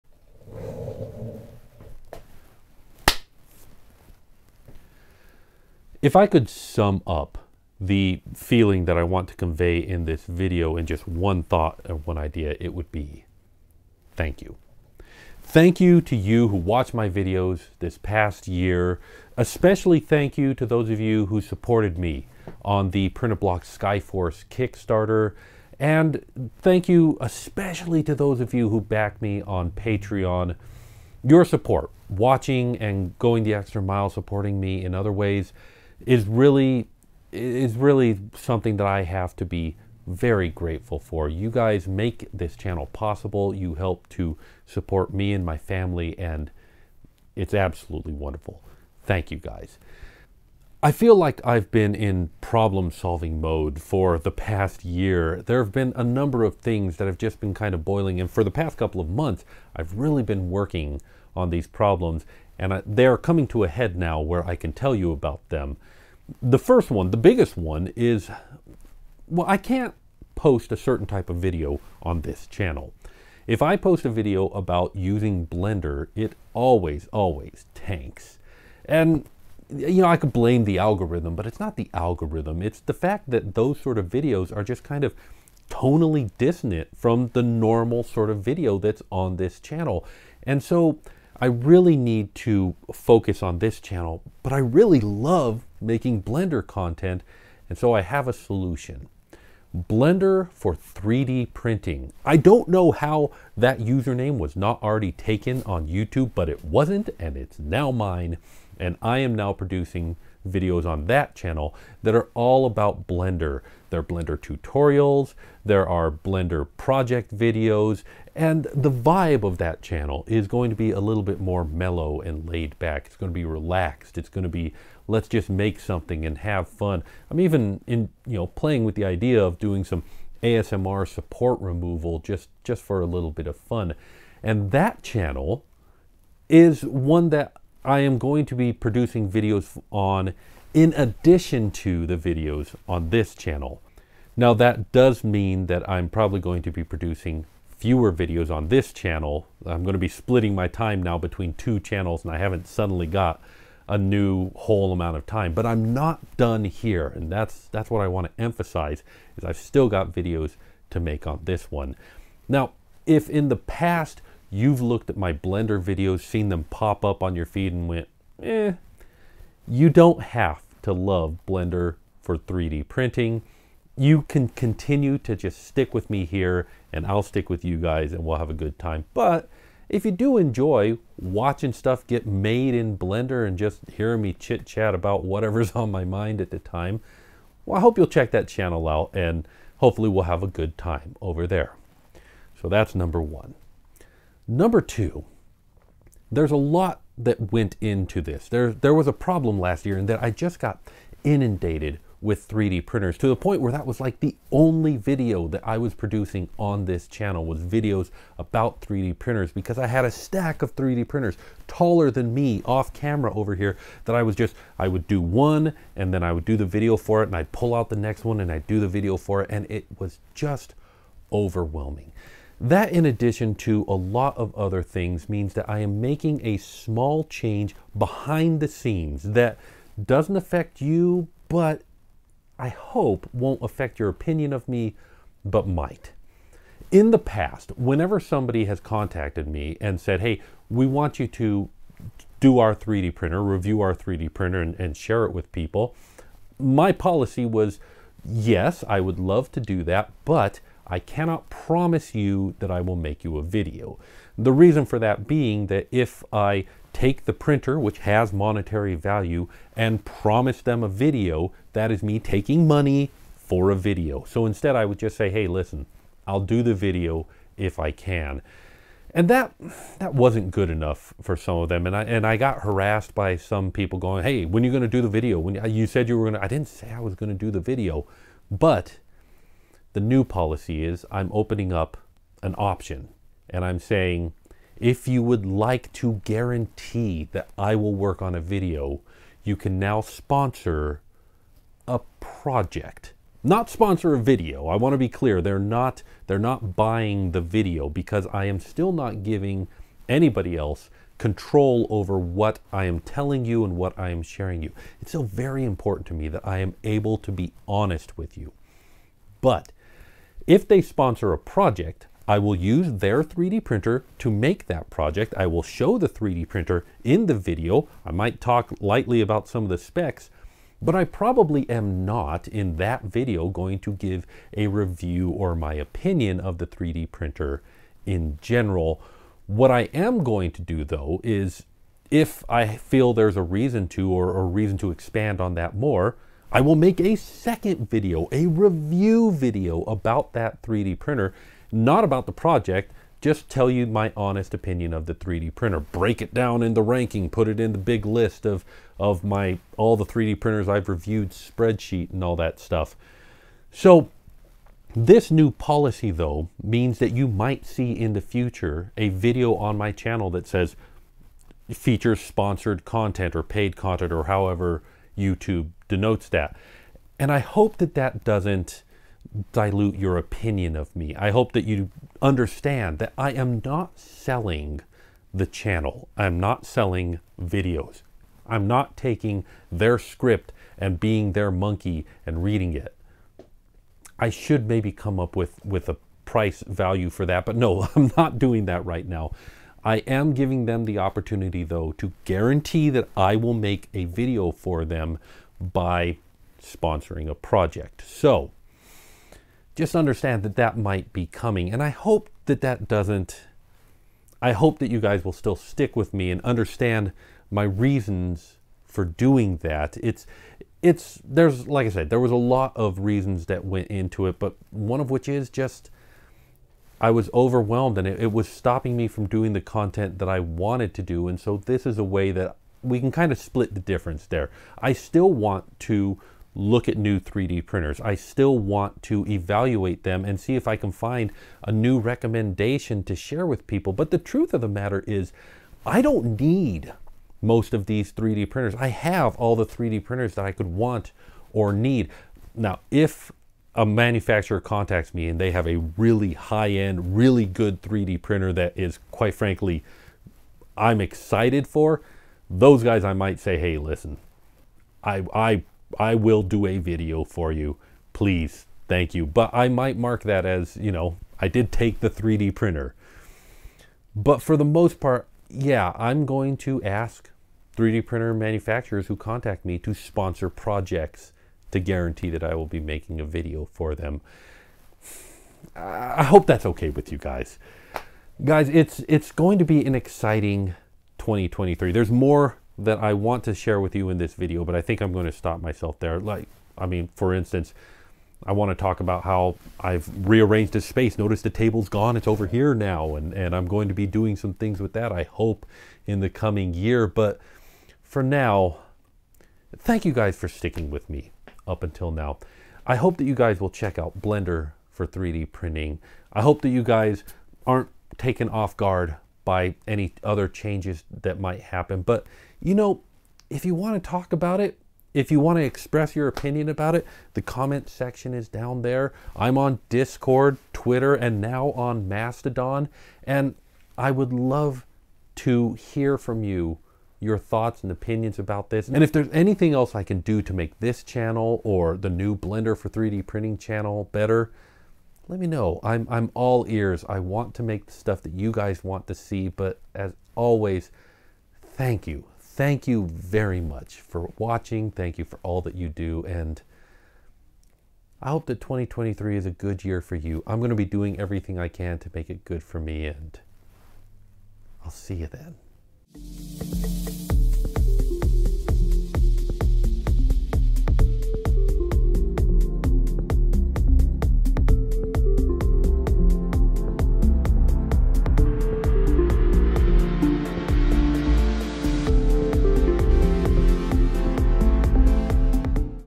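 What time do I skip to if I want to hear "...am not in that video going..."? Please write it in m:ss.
5:21.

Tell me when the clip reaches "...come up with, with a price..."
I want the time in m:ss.
6:24.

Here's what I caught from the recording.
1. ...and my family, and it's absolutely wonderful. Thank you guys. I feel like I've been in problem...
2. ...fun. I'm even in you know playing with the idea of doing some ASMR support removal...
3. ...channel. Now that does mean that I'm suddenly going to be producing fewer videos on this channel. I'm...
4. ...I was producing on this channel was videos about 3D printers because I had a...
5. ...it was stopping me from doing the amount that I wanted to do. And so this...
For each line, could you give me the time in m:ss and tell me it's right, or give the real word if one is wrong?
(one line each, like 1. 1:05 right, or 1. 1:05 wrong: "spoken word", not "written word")
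1. 0:45 right
2. 2:06 right
3. 2:23 wrong: "probably", not "suddenly"
4. 3:25 right
5. 6:58 wrong: "content", not "amount".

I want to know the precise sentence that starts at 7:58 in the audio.
Guys, it's it's going to be an exciting 2023.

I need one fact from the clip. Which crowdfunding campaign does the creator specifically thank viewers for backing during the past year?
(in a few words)
Printablock Skyforce.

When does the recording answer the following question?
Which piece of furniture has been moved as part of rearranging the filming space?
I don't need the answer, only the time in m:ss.
8:11.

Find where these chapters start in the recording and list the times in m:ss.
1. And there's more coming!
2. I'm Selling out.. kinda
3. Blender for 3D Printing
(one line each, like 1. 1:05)
1. 7:58
2. 3:11
3. 0:50.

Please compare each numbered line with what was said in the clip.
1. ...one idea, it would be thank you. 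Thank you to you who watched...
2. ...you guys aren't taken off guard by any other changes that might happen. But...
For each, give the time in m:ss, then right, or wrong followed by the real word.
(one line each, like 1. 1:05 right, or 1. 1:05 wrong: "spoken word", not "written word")
1. 0:11 right
2. 8:26 right.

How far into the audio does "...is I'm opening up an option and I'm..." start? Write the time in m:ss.
4:40.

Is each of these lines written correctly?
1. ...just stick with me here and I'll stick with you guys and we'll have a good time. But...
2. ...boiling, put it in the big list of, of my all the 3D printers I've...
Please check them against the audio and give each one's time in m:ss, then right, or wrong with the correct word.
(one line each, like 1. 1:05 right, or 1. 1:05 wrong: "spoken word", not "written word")
1. 2:55 right
2. 5:46 wrong: "ranking", not "boiling".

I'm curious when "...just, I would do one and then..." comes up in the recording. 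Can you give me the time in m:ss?
3:34.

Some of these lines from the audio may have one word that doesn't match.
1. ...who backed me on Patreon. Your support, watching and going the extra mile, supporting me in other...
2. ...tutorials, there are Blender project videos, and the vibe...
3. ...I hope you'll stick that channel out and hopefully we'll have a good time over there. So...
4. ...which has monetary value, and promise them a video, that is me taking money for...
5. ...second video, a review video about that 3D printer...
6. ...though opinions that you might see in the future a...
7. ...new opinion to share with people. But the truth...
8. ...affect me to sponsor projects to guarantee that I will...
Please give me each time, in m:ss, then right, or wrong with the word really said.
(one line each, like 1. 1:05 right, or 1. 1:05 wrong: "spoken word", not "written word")
1. 0:28 right
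2. 1:54 right
3. 3:07 wrong: "check", not "stick"
4. 4:17 right
5. 5:37 right
6. 5:56 wrong: "means", not "opinions"
7. 7:11 wrong: "recommendation", not "opinion"
8. 7:49 wrong: "contact", not "affect".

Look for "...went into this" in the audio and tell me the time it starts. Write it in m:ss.
3:17.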